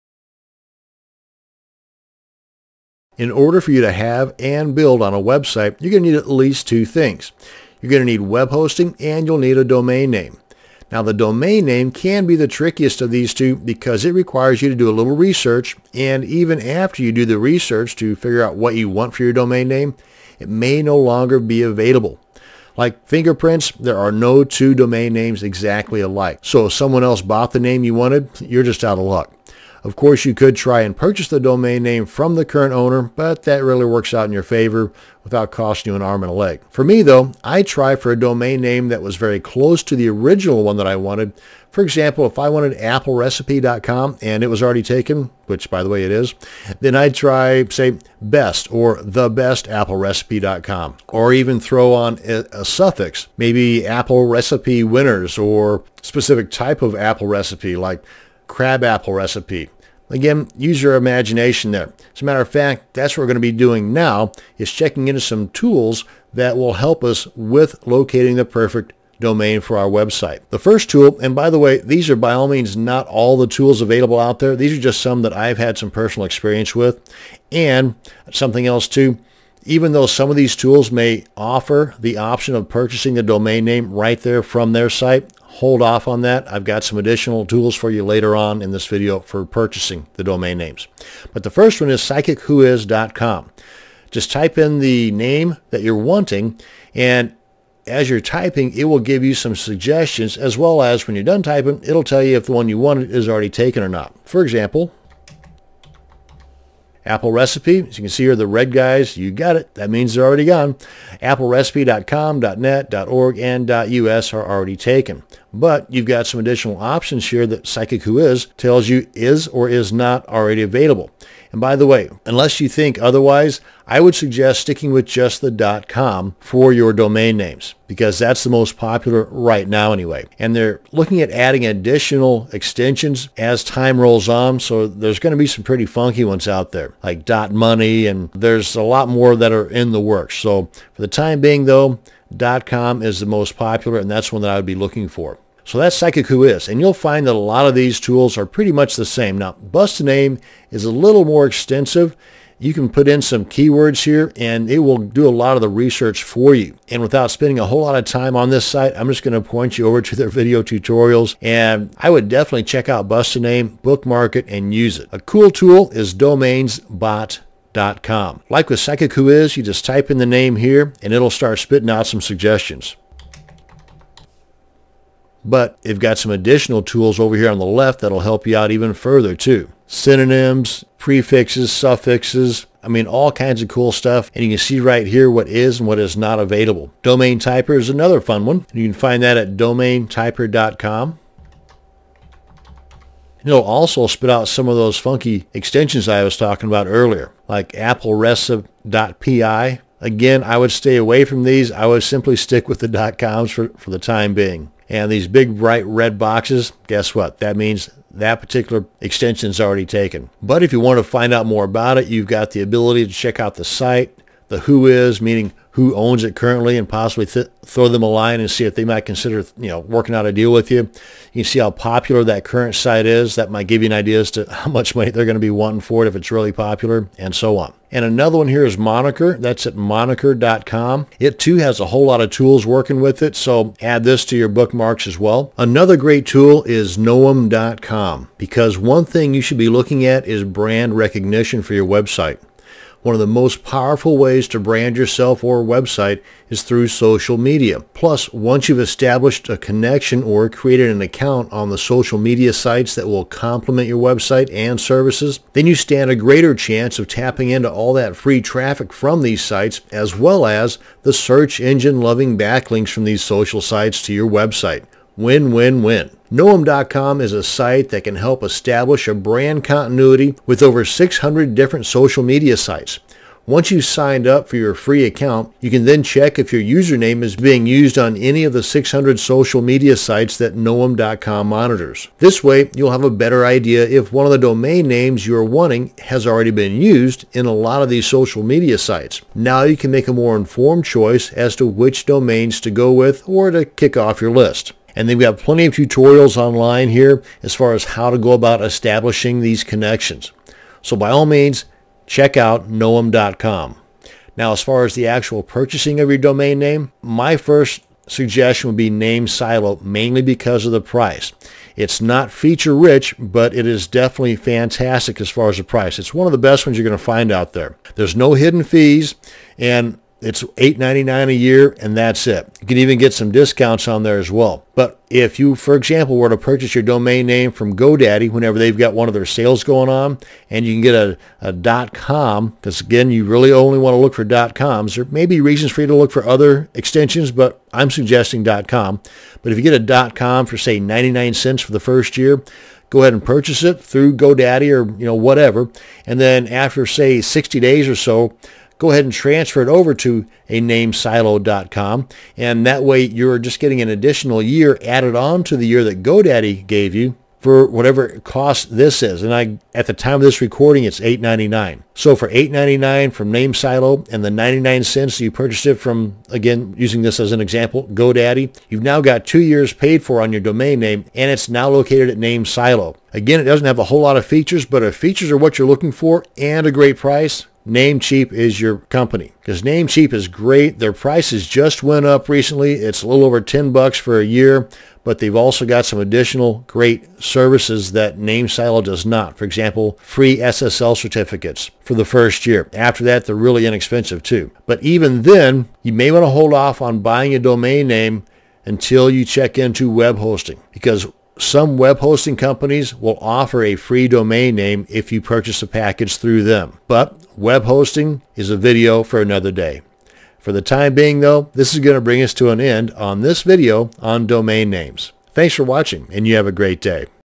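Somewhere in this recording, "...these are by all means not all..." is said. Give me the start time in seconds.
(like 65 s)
71 s.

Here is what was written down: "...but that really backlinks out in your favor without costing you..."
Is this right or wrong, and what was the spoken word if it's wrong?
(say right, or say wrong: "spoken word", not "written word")
wrong: "works", not "backlinks".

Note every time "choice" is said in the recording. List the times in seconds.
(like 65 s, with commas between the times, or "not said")
290 s.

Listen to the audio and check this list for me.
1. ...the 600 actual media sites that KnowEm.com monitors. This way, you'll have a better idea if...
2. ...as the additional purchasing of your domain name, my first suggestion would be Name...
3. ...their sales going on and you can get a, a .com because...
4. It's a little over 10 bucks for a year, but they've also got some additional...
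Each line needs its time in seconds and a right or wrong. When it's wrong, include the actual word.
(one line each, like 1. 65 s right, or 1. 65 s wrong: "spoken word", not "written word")
1. 278 s wrong: "social", not "actual"
2. 304 s wrong: "actual", not "additional"
3. 329 s right
4. 382 s right.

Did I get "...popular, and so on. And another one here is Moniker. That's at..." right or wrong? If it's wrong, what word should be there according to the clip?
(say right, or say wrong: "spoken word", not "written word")
right.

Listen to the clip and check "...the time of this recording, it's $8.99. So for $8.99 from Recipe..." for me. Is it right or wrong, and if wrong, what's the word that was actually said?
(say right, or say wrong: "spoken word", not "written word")
wrong: "Name", not "Recipe".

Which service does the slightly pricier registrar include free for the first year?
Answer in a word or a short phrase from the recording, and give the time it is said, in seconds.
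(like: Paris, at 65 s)
SSL certificates, at 390 s.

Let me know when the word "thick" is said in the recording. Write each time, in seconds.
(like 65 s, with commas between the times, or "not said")
not said.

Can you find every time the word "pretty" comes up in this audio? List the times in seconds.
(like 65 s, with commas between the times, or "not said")
135 s, 148 s.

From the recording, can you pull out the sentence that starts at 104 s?
For example, Apple Recipe, as you can see here, the red guys, you got it.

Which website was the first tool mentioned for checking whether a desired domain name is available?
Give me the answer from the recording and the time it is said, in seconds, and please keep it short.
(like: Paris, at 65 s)
psychicwhois.com, at 92 s.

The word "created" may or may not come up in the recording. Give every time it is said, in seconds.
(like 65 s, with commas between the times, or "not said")
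250 s.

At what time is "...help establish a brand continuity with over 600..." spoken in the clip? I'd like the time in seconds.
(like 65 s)
268 s.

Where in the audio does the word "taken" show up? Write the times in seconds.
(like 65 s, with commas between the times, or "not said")
44 s, 103 s, 114 s, 209 s.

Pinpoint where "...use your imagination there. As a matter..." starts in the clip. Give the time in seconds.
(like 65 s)
60 s.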